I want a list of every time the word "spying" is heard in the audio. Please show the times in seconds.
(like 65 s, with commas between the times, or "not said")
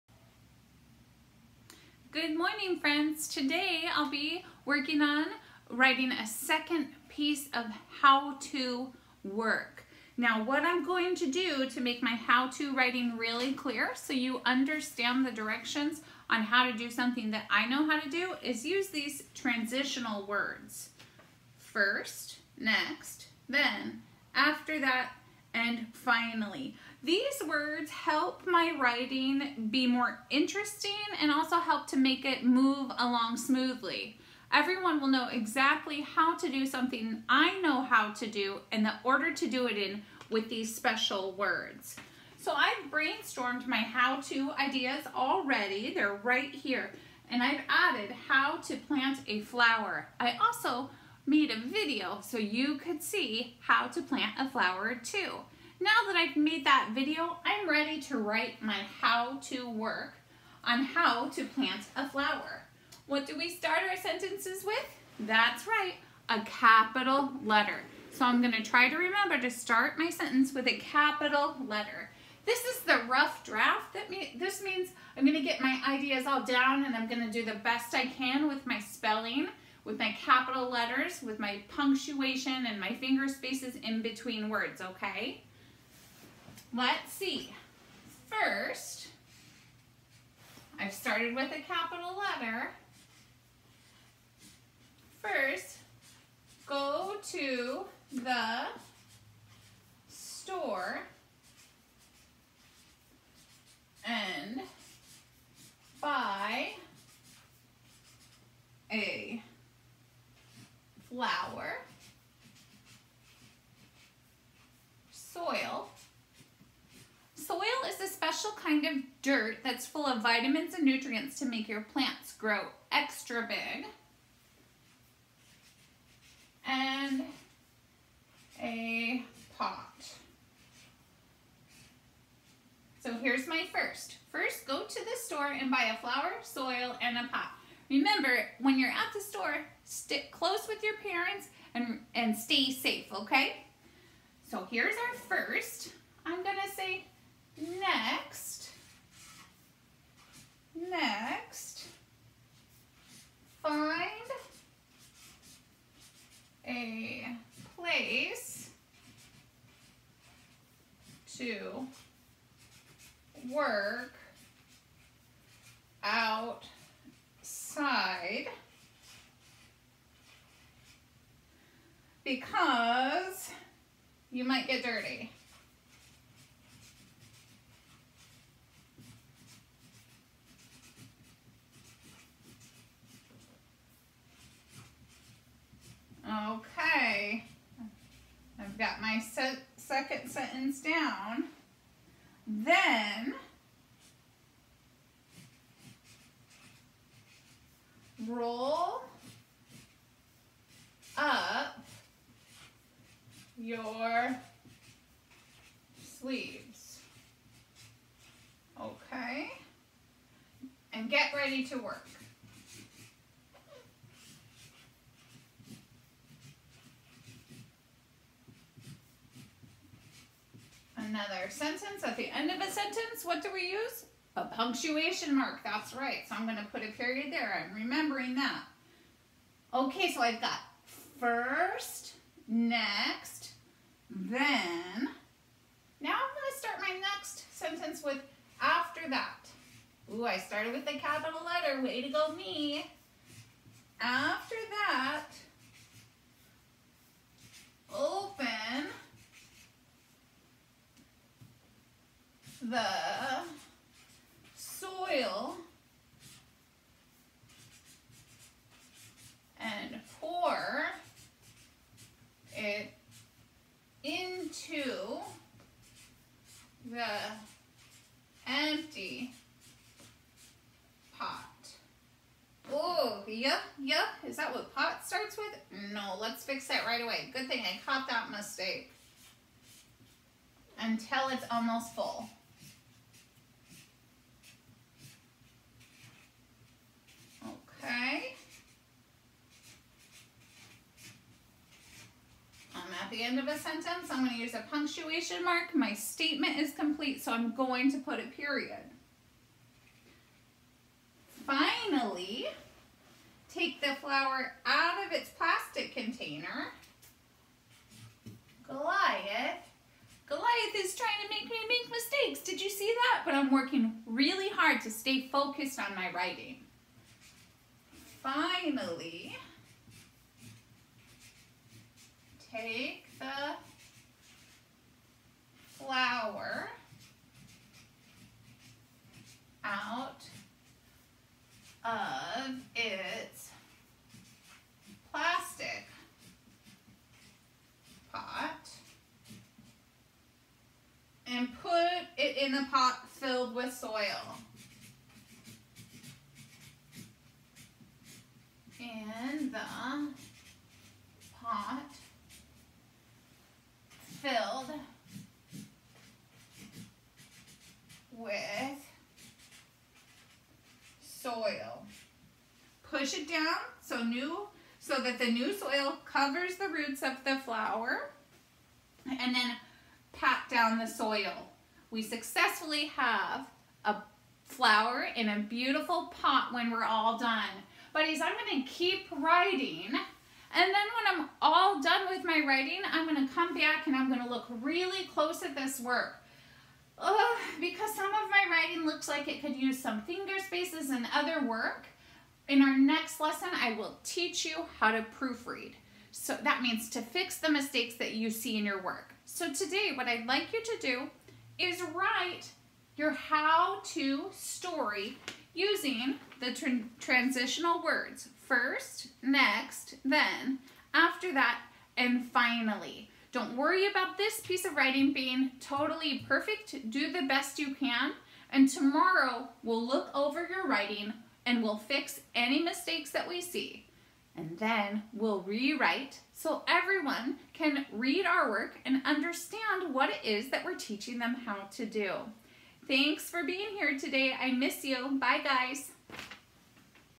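not said.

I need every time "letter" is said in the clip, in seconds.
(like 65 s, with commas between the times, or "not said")
67 s, 71 s, 80 s, 92 s, 241 s.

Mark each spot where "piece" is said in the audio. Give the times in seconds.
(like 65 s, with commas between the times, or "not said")
7 s, 414 s.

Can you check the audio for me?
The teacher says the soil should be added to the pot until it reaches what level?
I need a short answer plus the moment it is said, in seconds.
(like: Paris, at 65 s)
Almost full, at 281 s.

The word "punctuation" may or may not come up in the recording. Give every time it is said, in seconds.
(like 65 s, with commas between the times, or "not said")
81 s, 224 s, 294 s.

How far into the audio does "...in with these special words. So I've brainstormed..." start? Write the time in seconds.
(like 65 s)
39 s.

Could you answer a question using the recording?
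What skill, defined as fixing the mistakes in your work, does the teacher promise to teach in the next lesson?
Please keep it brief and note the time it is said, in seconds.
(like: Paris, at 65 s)
Proofread, at 395 s.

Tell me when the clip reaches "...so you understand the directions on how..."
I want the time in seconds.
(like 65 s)
13 s.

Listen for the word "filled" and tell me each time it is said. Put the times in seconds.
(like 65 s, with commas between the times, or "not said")
343 s, 354 s.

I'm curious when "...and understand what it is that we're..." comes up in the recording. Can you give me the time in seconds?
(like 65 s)
428 s.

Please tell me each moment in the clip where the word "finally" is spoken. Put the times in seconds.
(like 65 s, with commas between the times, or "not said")
25 s, 318 s, 412 s.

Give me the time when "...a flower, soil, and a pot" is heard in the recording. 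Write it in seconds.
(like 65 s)
135 s.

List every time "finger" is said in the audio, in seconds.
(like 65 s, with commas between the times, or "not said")
82 s, 390 s.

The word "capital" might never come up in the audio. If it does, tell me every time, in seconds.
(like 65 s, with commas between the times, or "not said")
66 s, 70 s, 80 s, 91 s, 240 s.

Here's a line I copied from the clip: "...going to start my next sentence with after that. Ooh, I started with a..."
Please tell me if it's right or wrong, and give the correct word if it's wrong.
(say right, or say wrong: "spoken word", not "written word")
right.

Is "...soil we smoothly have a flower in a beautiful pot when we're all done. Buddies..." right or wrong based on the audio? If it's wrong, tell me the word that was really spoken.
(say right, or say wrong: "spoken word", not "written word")
wrong: "successfully", not "smoothly".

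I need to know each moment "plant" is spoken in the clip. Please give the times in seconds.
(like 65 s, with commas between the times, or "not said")
48 s, 54 s, 61 s, 121 s.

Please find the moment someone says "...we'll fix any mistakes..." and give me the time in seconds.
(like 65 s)
421 s.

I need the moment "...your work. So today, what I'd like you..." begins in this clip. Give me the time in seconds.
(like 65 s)
398 s.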